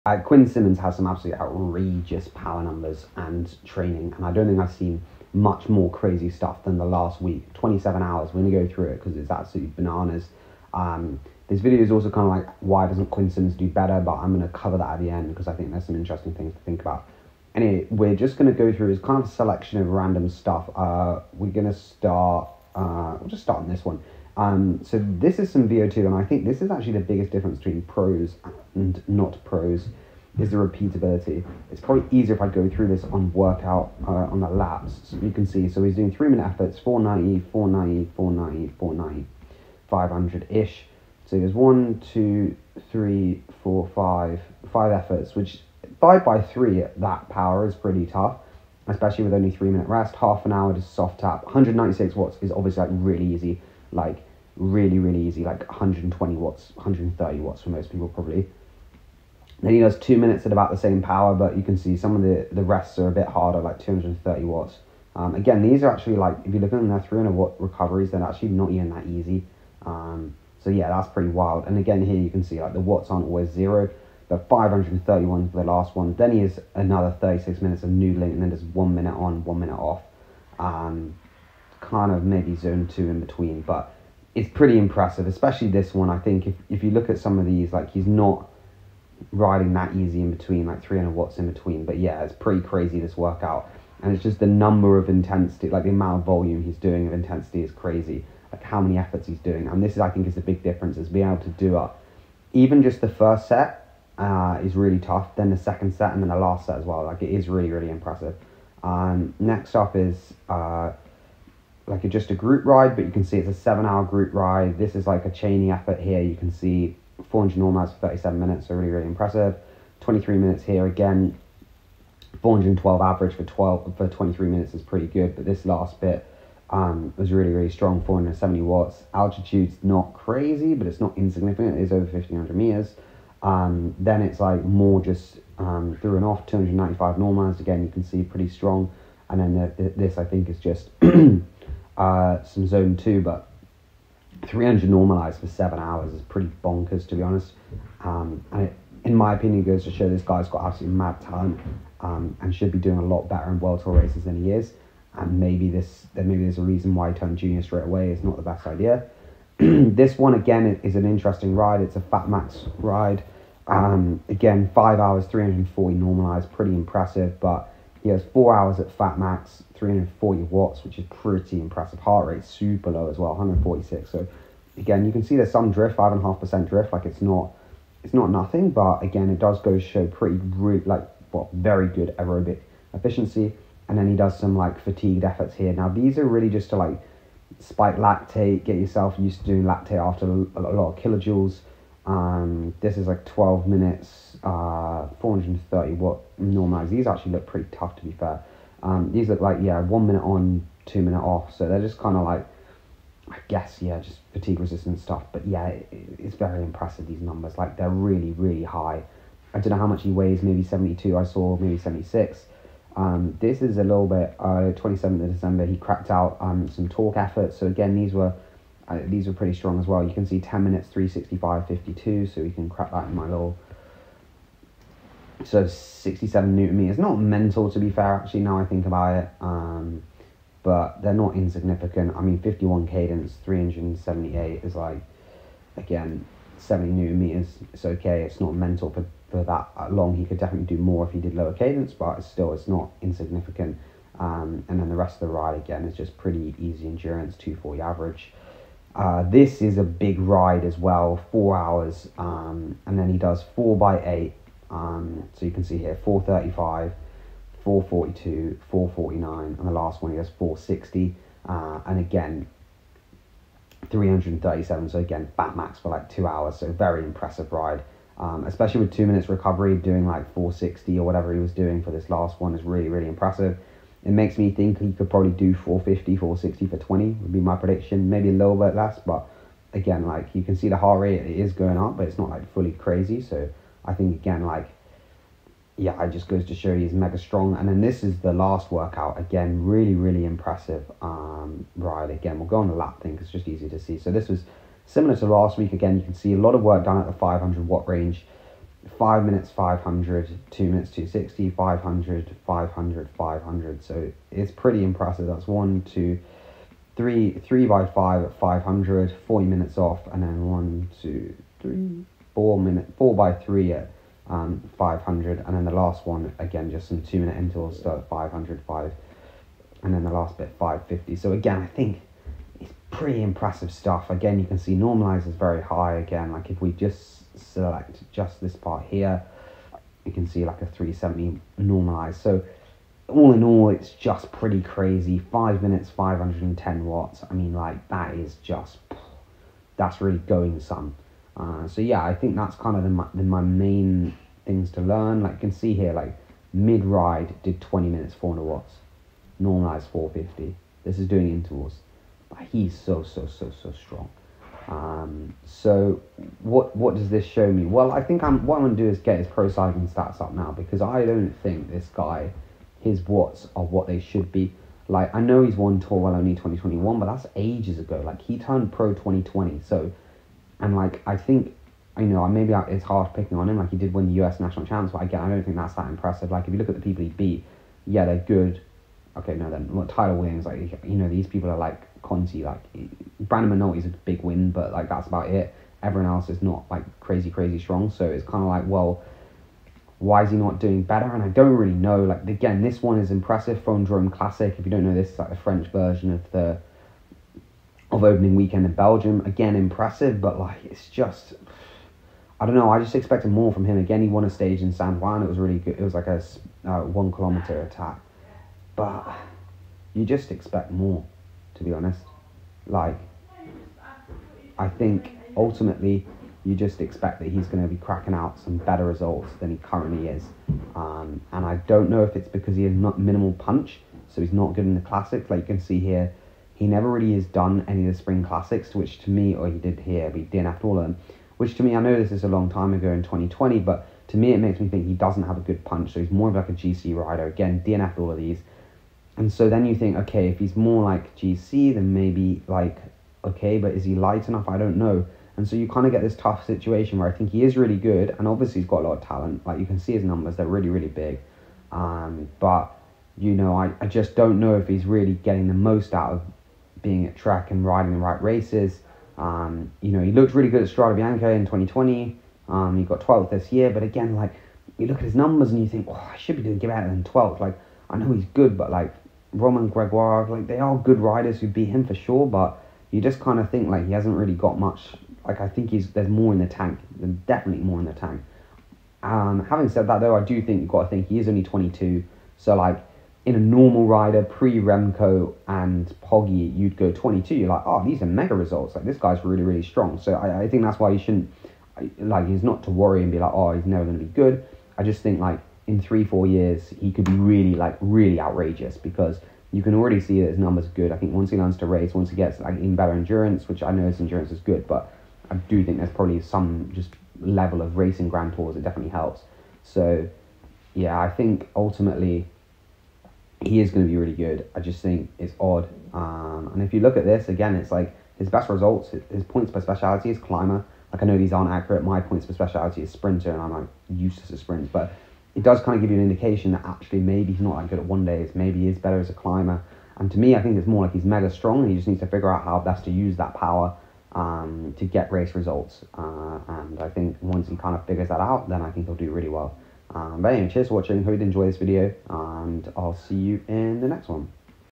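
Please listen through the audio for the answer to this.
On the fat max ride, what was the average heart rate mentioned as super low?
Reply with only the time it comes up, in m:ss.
2:53.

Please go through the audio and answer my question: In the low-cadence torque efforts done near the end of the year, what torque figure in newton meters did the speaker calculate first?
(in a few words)
67.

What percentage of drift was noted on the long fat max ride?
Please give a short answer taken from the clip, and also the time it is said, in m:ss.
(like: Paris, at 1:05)
5.5%, at 2:55.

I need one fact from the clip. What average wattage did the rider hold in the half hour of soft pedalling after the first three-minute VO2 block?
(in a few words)
196 watts.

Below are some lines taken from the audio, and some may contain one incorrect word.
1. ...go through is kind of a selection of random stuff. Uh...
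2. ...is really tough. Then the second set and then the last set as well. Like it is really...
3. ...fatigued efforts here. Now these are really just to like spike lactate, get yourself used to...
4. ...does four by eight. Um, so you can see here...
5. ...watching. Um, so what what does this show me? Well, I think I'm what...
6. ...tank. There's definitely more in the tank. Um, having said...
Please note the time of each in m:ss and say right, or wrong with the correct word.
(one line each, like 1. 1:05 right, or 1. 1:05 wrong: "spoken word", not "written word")
1. 0:18 right
2. 1:44 right
3. 3:04 right
4. 4:13 right
5. 5:53 wrong: "strong", not "watching"
6. 7:56 right.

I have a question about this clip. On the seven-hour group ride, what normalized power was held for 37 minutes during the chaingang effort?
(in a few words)
400.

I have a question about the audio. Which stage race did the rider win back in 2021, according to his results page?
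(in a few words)
Tour Wallonie.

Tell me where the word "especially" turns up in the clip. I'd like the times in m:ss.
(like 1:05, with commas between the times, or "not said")
0:48, 1:25, 4:28.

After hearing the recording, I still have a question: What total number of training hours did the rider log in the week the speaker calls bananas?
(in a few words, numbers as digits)
27.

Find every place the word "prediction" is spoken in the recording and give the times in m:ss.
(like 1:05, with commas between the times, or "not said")
4:37.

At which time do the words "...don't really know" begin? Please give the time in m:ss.
6:31.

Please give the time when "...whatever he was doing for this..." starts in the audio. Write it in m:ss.
4:31.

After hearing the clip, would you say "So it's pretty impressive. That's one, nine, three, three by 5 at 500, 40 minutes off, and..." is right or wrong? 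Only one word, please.
wrong.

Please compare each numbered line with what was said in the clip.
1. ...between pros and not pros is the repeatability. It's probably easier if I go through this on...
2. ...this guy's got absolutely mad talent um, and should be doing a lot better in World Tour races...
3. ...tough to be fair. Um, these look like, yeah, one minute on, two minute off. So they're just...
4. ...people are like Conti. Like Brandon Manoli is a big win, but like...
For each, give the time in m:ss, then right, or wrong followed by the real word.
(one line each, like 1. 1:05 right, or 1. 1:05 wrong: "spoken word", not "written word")
1. 0:27 right
2. 2:30 right
3. 3:17 right
4. 6:21 right.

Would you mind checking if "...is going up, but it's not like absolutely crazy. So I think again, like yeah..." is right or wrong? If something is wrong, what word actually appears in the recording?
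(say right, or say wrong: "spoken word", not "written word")
wrong: "fully", not "absolutely".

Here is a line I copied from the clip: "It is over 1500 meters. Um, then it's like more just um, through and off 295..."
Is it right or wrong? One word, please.
right.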